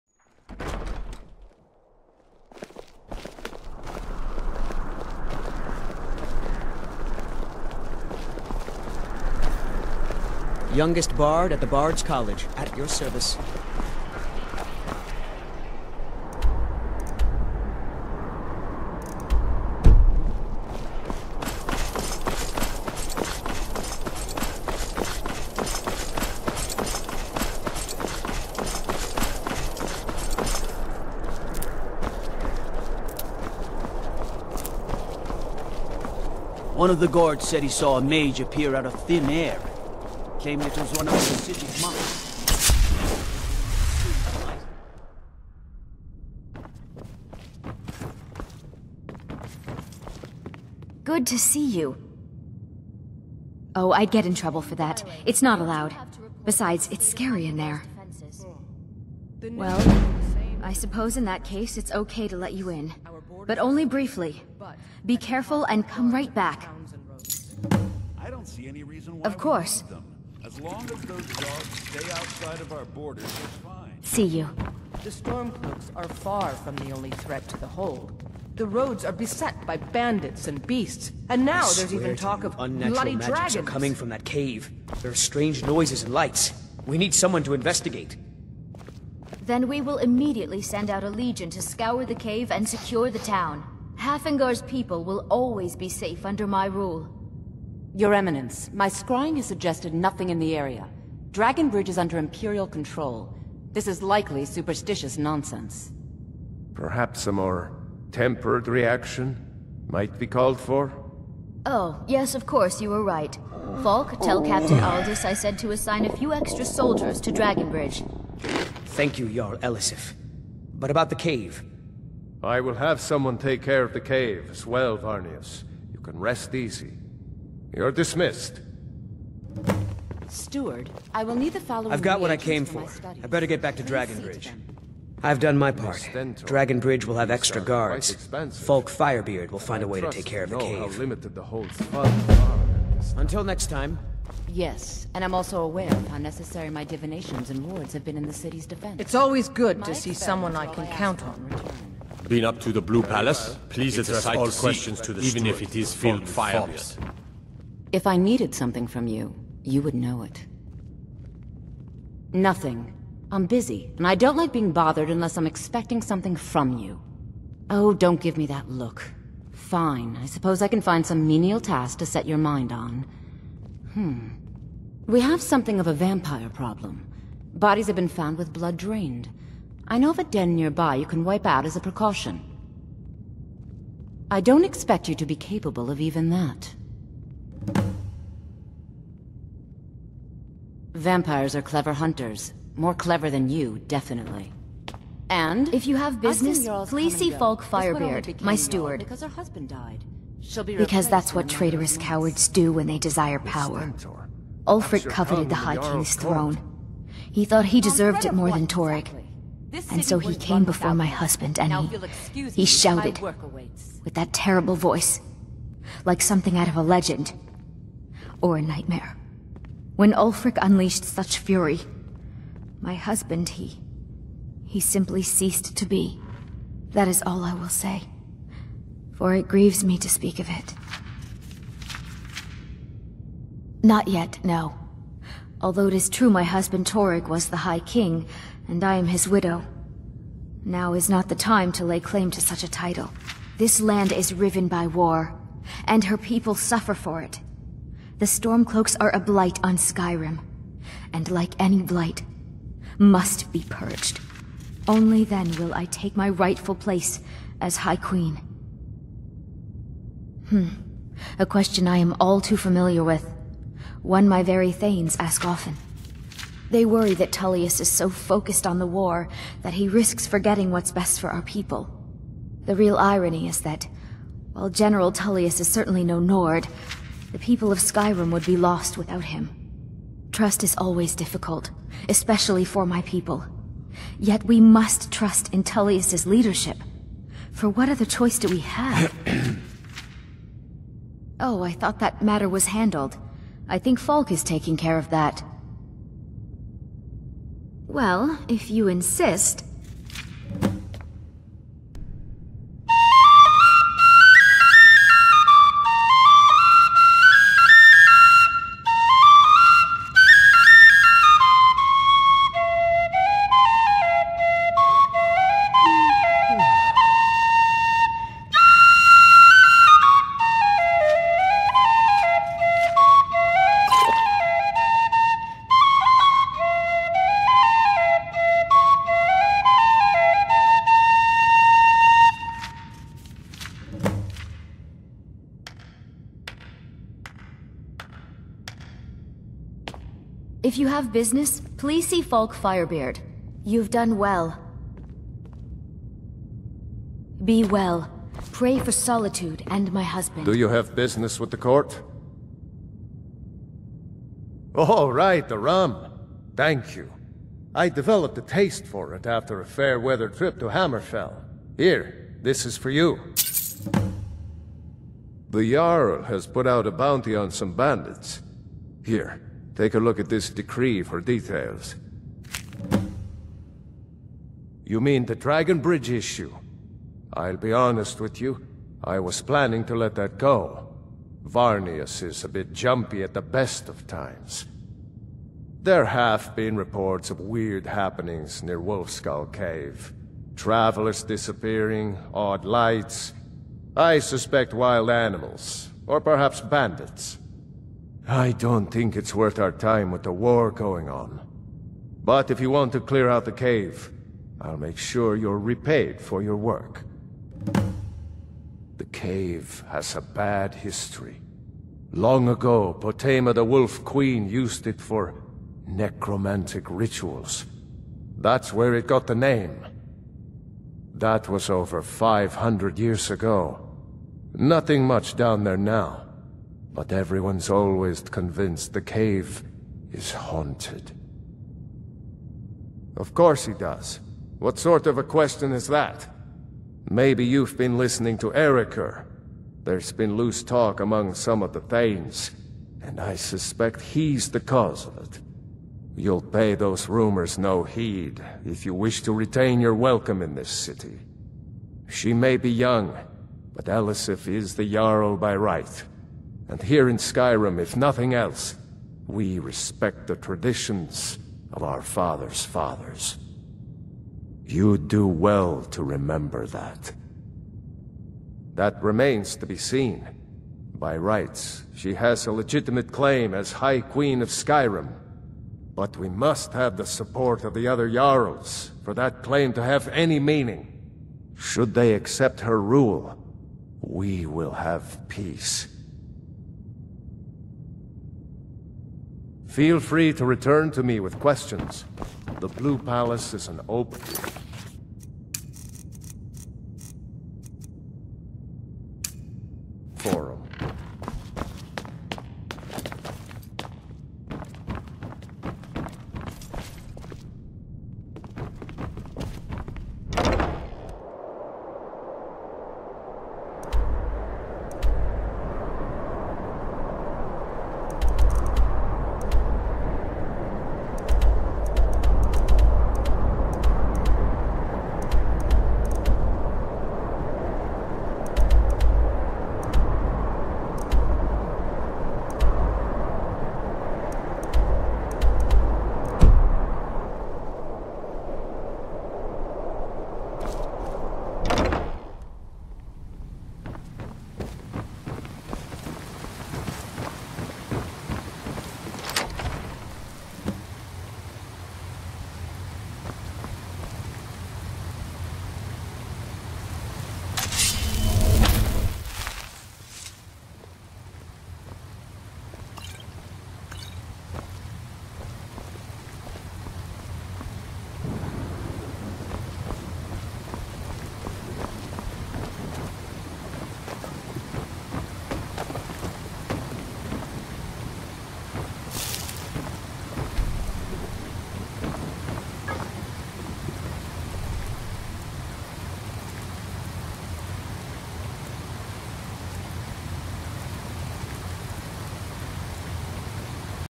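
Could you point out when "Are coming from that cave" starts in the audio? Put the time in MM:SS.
01:23.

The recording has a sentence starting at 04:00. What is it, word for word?
Now is not the time to lay claim to such a title.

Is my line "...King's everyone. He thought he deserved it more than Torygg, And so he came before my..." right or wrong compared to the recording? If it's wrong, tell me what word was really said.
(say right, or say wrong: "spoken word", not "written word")
wrong: "throne", not "everyone".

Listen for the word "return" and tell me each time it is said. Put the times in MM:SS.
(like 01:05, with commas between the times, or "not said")
02:31, 08:10.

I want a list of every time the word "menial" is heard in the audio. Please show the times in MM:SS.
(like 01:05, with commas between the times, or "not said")
02:51.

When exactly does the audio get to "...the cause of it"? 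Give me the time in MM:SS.
07:24.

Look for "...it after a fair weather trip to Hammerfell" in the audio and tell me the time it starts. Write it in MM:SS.
05:59.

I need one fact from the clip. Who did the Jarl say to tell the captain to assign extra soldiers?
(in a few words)
Aldis.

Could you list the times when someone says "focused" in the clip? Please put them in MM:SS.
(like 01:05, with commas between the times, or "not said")
04:28.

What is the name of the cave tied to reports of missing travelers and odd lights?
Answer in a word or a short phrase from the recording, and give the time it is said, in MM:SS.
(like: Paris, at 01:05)
Wolfskull Cave, at 06:28.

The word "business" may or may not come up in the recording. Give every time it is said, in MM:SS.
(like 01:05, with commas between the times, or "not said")
03:16, 05:41, 05:50.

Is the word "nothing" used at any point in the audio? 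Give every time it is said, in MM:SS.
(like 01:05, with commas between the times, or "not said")
01:39, 02:42, 07:04, 07:37.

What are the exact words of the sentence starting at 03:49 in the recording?
For it grieves me to speak of it.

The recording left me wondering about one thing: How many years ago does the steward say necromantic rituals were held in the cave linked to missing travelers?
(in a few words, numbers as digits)
500.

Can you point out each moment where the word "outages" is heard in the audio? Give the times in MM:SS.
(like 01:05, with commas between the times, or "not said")
not said.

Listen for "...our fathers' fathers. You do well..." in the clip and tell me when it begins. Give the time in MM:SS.
07:41.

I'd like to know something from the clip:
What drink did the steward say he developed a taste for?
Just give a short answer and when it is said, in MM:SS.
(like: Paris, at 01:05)
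Rum, at 05:55.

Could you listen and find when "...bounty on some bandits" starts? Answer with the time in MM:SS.
06:06.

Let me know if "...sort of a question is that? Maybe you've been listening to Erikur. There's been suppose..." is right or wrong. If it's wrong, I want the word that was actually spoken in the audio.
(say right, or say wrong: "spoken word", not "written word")
wrong: "loose", not "suppose".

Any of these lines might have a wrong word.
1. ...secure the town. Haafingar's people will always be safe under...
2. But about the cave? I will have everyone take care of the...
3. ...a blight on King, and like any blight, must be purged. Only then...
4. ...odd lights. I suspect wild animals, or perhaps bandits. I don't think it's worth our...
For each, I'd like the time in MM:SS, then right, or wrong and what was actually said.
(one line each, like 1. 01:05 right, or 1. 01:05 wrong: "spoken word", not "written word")
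1. 01:32 right
2. 02:00 wrong: "someone", not "everyone"
3. 04:09 wrong: "Skyrim", not "King"
4. 06:32 right.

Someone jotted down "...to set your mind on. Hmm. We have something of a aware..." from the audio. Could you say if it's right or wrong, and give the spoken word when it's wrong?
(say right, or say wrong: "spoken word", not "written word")
wrong: "vampire", not "aware".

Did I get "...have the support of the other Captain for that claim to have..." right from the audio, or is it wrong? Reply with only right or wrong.
wrong.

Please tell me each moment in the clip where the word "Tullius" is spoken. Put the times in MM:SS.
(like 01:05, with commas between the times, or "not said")
04:27, 04:35, 04:45.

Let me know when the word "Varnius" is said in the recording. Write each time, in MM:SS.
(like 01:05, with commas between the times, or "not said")
02:04, 06:21.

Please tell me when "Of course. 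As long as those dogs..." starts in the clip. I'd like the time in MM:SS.
01:09.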